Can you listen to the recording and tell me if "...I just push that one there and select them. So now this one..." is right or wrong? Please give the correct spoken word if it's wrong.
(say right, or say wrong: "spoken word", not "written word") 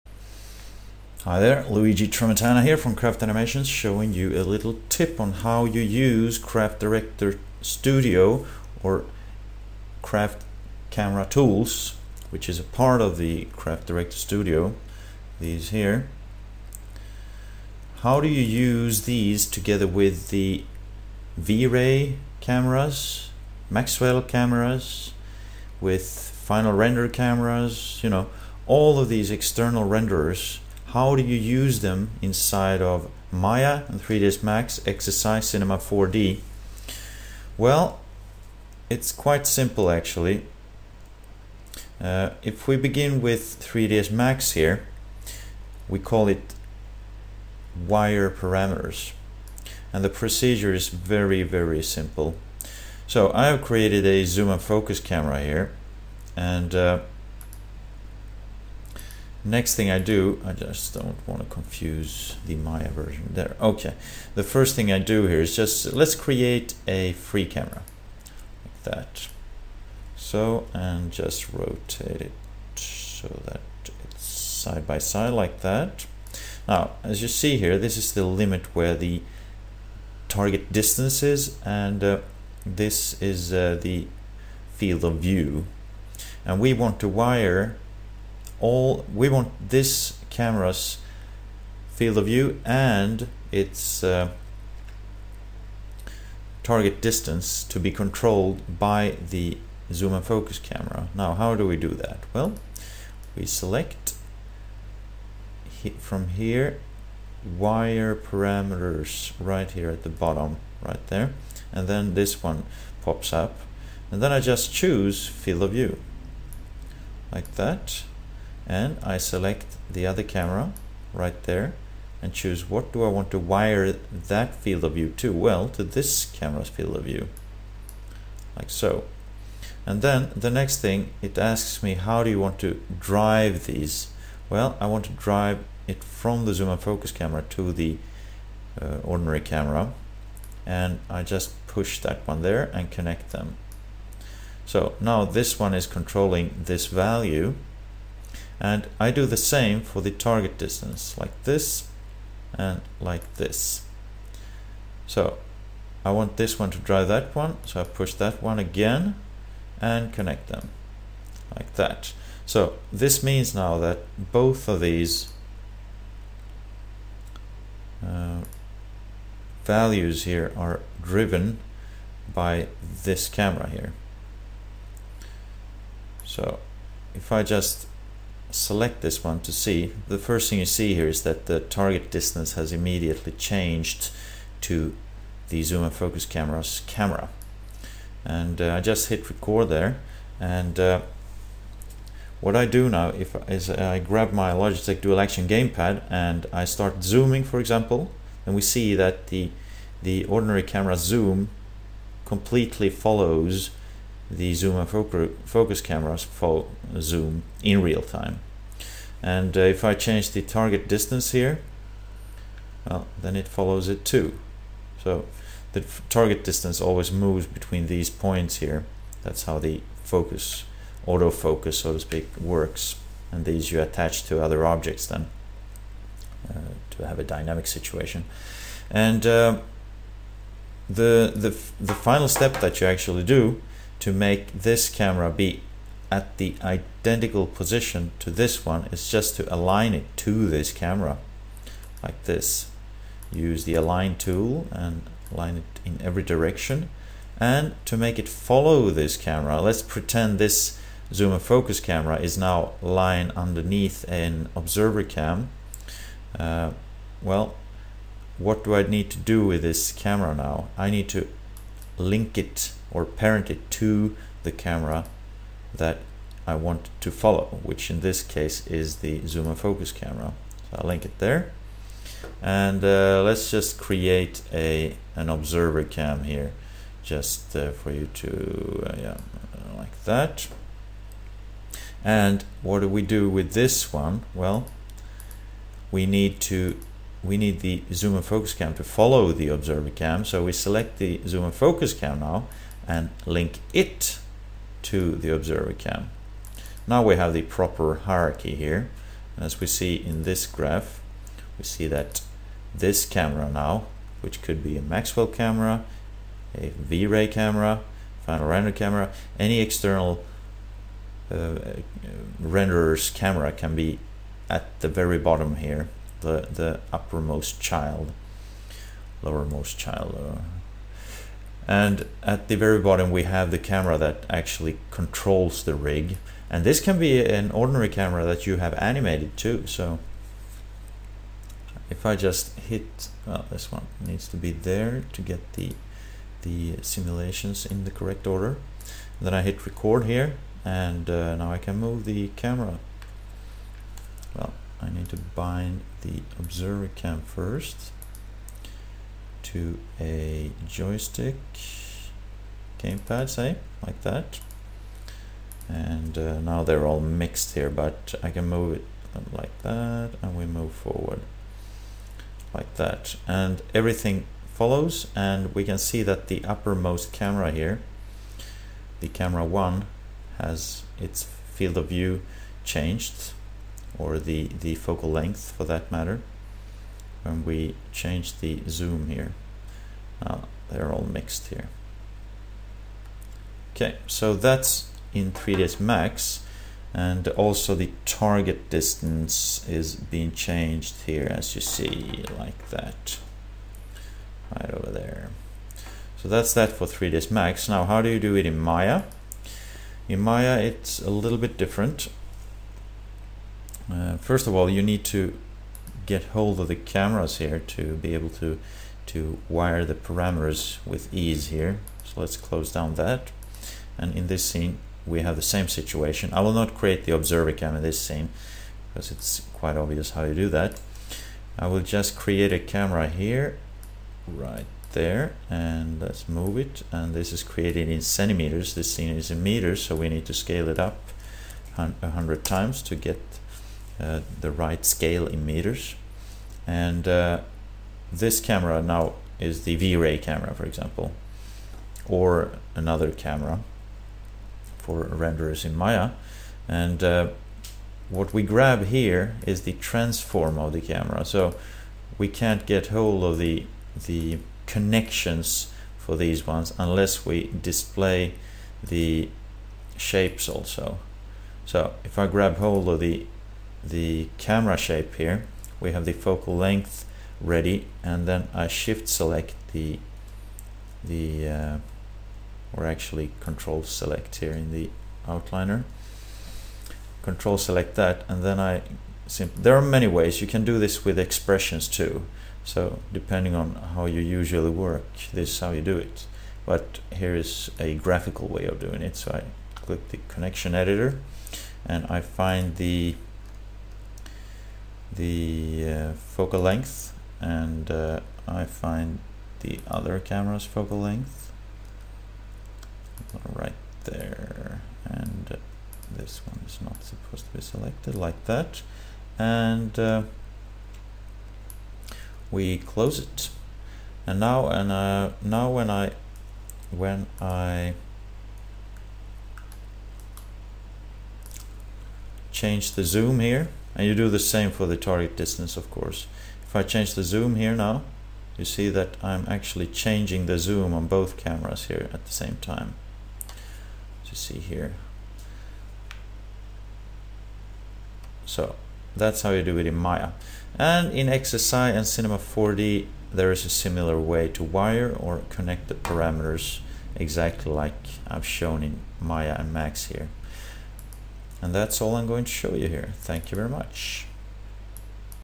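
wrong: "connect", not "select".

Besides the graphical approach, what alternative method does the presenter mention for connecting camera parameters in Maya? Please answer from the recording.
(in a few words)
expressions.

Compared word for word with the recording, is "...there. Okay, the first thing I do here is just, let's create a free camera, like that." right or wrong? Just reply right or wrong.
right.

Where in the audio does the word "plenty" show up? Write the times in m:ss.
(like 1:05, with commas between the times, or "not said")
not said.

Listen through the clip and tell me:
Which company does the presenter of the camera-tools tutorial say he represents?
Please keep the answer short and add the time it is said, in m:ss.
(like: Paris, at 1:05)
Craft Animations, at 0:02.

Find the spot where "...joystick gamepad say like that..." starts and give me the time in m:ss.
5:50.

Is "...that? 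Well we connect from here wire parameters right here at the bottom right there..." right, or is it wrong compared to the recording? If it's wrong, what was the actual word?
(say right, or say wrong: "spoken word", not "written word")
wrong: "select", not "connect".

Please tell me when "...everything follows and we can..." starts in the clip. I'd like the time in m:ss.
6:03.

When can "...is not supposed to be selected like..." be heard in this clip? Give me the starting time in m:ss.
8:26.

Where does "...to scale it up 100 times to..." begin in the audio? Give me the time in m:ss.
7:10.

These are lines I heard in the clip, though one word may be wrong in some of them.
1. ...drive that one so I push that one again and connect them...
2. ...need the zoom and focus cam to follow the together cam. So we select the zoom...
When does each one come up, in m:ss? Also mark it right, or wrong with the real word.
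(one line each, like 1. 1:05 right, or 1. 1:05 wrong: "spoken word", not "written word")
1. 2:36 right
2. 4:47 wrong: "observer", not "together".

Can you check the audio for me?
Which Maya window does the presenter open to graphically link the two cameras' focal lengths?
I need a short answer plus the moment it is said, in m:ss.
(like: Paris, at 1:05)
connection editor, at 8:10.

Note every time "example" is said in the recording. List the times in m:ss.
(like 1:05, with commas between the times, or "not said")
3:17, 7:20.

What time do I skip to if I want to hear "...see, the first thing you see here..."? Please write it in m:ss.
2:59.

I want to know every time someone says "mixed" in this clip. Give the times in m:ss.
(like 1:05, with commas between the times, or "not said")
5:56, 6:21.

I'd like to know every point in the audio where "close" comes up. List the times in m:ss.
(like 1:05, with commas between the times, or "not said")
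6:52, 8:32.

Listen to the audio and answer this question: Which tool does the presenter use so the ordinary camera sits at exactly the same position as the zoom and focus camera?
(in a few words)
align tool.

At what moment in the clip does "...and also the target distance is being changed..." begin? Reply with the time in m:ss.
6:26.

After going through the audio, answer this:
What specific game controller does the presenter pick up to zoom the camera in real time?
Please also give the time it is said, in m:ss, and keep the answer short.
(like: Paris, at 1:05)
Logitech dual action gamepad, at 3:14.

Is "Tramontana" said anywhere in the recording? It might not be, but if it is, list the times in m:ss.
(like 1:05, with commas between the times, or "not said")
0:02.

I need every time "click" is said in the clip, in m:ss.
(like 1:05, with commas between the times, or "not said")
8:09.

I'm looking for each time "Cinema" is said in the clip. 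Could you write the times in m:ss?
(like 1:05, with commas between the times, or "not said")
0:35, 9:02.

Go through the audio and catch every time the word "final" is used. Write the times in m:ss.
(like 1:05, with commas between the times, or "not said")
0:26, 3:51, 5:08.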